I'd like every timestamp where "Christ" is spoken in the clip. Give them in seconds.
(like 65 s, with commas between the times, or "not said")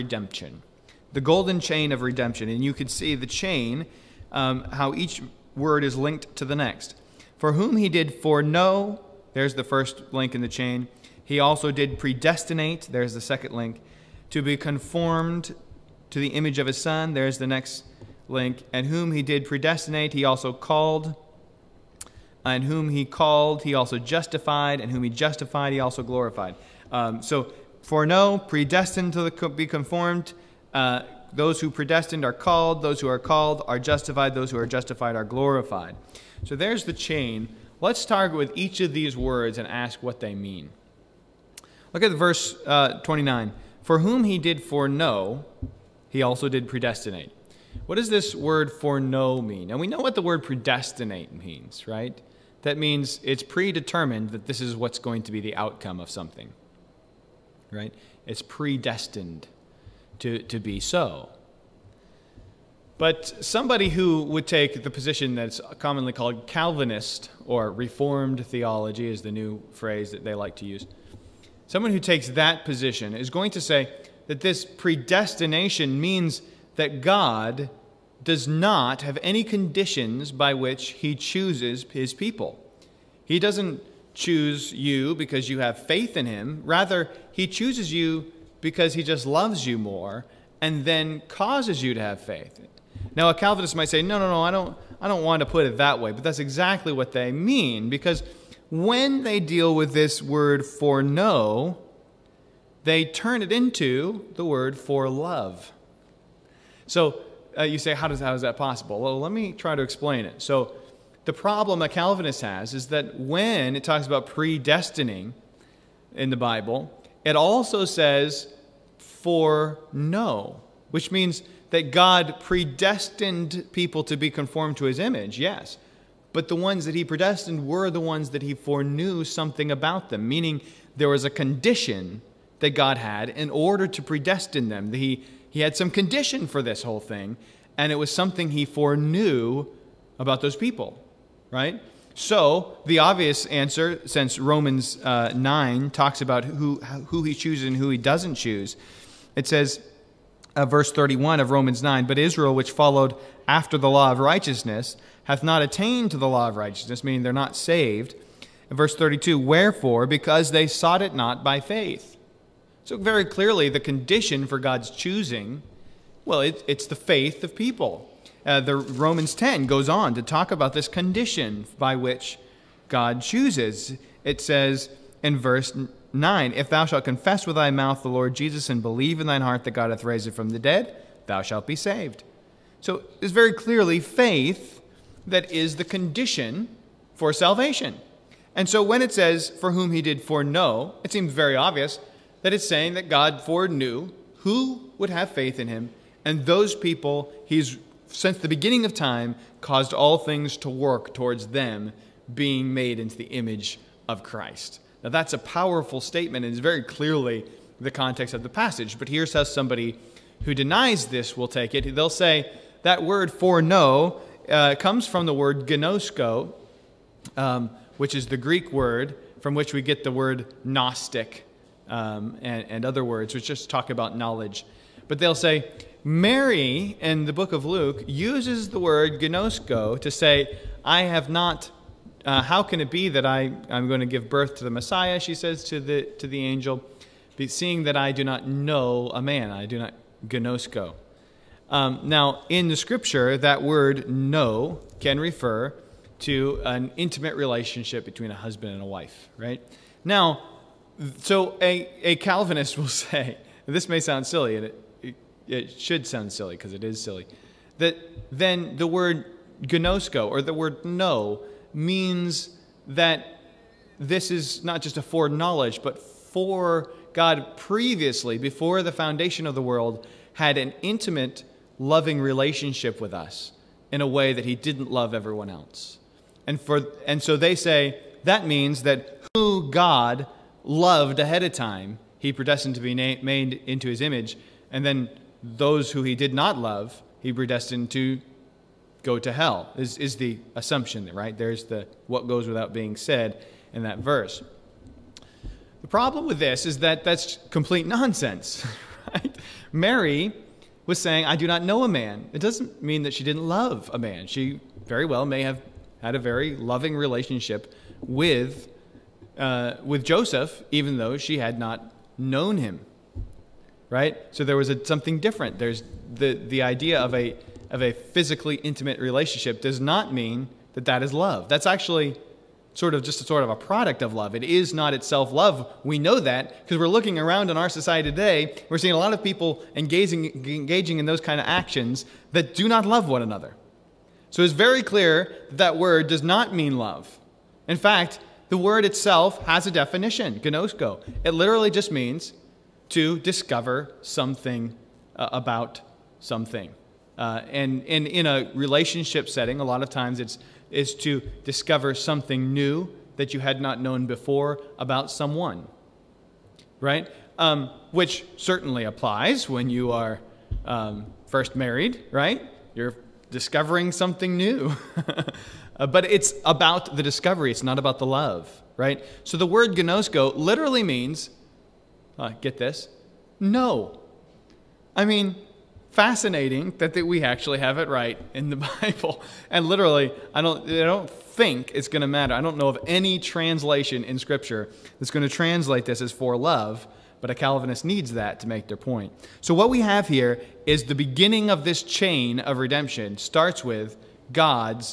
204 s.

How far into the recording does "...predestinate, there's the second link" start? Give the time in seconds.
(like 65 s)
11 s.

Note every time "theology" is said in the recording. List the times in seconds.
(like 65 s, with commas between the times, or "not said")
68 s.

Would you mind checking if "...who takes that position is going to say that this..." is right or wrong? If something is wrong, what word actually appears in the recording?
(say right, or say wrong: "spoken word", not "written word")
right.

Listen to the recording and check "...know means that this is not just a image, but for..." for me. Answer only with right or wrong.
wrong.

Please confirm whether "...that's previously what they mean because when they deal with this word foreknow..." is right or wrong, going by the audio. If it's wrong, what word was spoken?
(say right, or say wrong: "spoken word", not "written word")
wrong: "exactly", not "previously".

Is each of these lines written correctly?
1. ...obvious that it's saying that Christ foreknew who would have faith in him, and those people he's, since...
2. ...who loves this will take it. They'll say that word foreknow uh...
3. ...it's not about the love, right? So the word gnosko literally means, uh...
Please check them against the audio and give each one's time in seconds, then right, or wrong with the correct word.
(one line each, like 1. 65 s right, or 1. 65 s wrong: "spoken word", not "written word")
1. 191 s wrong: "God", not "Christ"
2. 210 s wrong: "denies", not "loves"
3. 367 s right.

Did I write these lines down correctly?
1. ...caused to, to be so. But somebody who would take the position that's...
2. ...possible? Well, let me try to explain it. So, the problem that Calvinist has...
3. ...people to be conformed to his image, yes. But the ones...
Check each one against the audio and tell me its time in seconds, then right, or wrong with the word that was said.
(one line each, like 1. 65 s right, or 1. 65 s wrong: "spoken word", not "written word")
1. 58 s wrong: "predestined", not "caused"
2. 108 s right
3. 123 s right.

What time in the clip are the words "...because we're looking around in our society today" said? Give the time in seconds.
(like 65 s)
326 s.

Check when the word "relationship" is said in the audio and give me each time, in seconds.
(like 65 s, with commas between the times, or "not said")
247 s, 272 s, 306 s, 318 s, 348 s.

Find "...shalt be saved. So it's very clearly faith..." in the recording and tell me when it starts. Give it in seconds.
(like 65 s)
181 s.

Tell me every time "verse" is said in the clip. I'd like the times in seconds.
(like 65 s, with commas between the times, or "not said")
42 s, 150 s, 158 s, 175 s, 293 s.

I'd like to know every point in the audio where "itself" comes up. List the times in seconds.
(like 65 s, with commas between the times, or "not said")
324 s, 338 s.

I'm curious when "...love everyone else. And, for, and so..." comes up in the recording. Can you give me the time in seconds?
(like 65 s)
274 s.